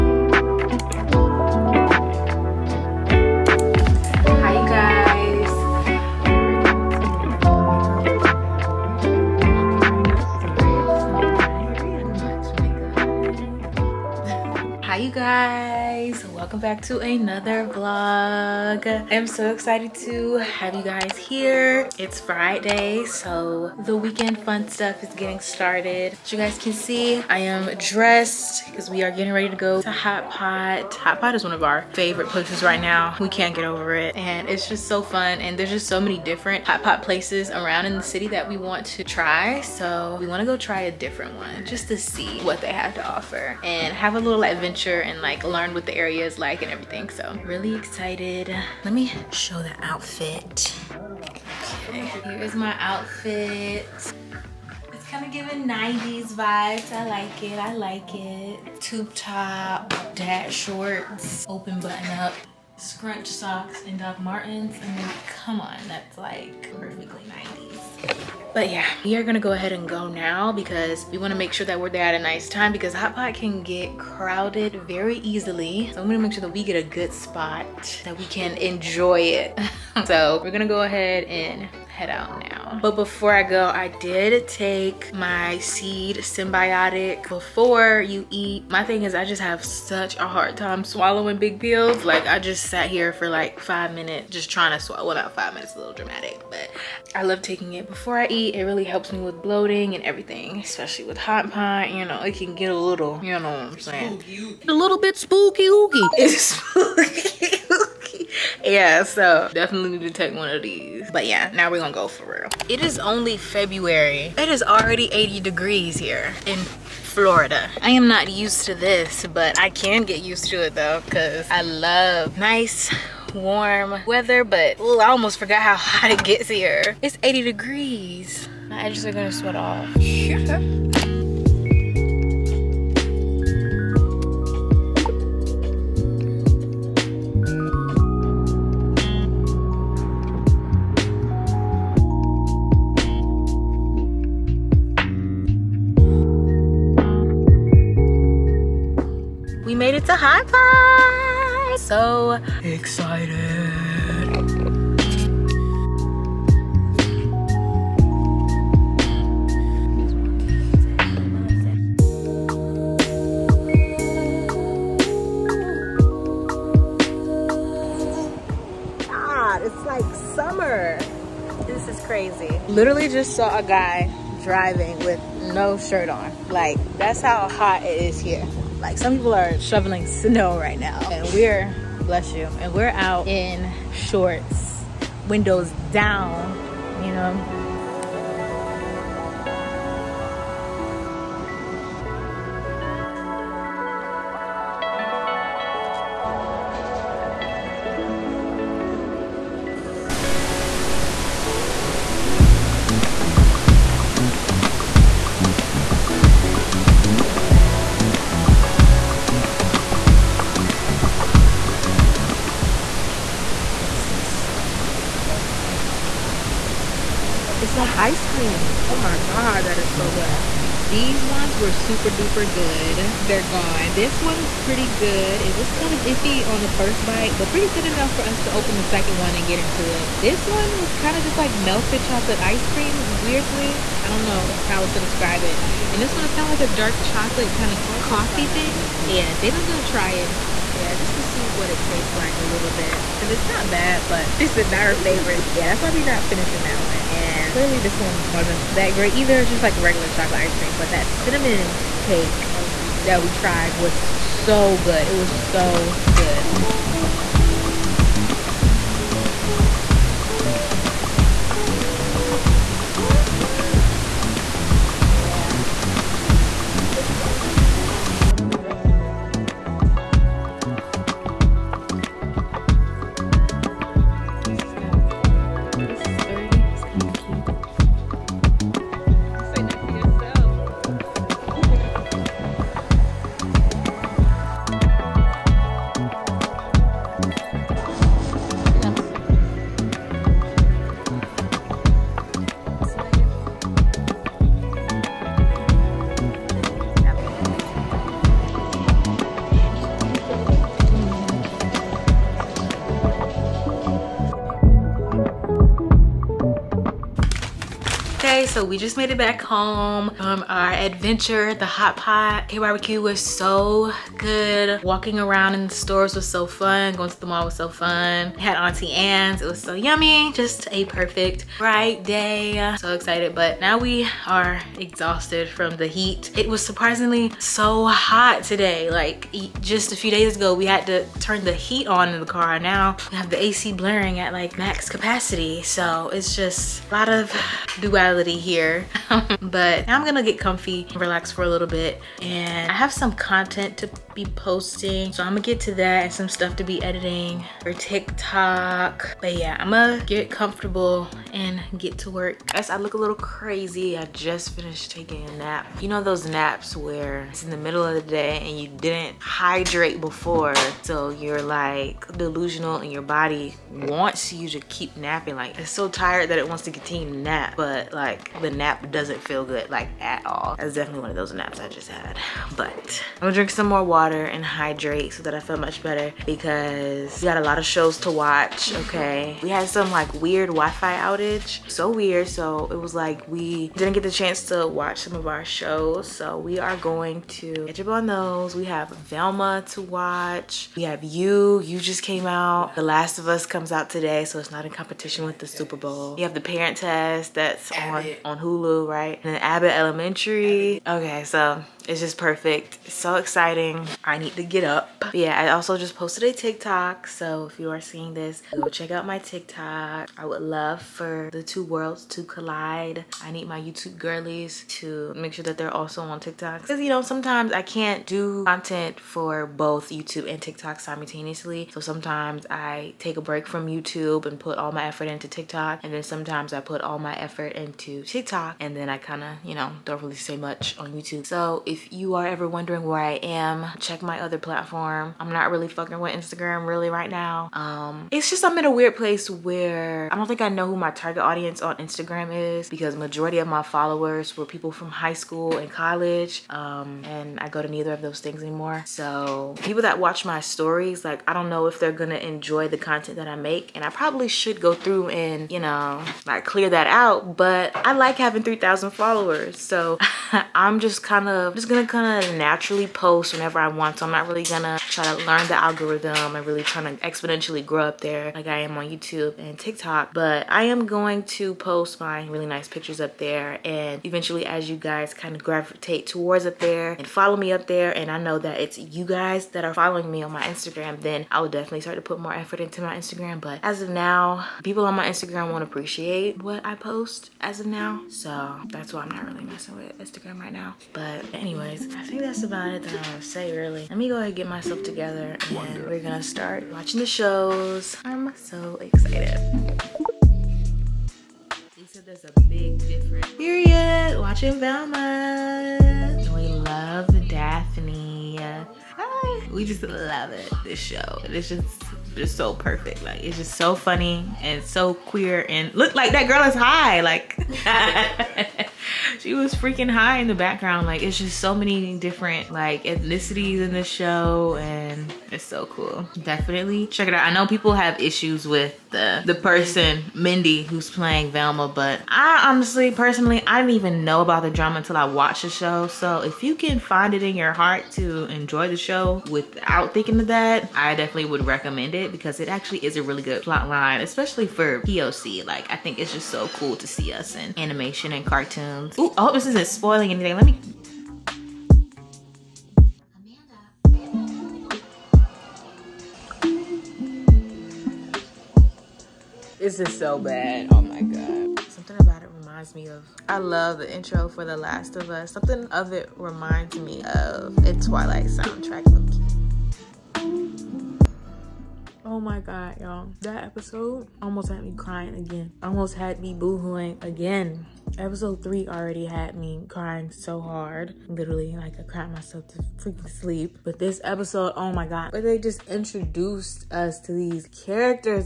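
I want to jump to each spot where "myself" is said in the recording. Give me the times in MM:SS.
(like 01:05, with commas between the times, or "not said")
08:14, 09:42.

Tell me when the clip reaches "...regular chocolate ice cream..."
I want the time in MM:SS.
04:09.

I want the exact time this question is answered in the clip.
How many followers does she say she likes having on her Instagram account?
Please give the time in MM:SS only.
07:38.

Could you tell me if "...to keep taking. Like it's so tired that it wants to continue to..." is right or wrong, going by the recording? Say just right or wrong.
wrong.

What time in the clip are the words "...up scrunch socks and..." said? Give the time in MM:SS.
01:02.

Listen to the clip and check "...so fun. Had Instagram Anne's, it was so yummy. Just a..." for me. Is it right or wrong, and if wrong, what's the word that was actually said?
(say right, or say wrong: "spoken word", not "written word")
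wrong: "Auntie", not "Instagram".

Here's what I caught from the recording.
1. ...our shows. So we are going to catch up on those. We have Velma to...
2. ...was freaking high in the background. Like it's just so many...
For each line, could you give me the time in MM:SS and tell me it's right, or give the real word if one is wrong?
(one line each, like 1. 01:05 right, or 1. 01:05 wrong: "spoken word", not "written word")
1. 06:25 right
2. 08:39 right.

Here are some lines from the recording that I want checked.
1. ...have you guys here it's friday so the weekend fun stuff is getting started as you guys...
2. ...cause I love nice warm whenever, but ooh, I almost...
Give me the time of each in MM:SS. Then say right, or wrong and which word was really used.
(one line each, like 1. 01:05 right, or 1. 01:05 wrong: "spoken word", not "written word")
1. 00:20 right
2. 02:01 wrong: "weather", not "whenever".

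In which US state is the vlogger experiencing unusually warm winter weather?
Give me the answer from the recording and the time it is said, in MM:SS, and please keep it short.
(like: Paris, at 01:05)
Florida, at 01:57.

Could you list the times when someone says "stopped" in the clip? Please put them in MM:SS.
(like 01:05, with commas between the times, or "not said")
not said.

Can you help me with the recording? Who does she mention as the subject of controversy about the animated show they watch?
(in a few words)
Mindy.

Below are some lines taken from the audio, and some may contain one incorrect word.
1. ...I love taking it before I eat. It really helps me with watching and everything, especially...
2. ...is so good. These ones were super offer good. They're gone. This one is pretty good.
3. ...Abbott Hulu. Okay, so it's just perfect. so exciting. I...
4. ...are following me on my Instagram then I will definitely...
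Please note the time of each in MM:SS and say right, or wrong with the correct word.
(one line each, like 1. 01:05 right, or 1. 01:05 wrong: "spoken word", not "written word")
1. 01:37 wrong: "bloating", not "watching"
2. 03:39 wrong: "duper", not "offer"
3. 06:39 wrong: "Elementary", not "Hulu"
4. 07:59 right.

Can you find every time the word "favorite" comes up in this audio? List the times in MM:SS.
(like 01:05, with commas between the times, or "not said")
00:31, 04:04.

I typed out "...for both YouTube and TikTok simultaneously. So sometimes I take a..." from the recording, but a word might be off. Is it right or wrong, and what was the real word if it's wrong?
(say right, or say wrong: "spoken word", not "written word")
right.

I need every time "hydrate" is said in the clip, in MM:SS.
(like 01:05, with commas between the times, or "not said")
05:59, 06:14.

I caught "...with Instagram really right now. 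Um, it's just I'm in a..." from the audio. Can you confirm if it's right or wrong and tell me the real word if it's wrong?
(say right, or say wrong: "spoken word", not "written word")
right.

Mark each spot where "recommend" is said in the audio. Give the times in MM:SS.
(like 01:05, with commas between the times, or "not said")
09:01.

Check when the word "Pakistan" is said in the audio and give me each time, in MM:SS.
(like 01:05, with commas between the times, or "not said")
not said.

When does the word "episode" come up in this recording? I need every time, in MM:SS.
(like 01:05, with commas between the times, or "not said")
09:33, 09:37, 09:44.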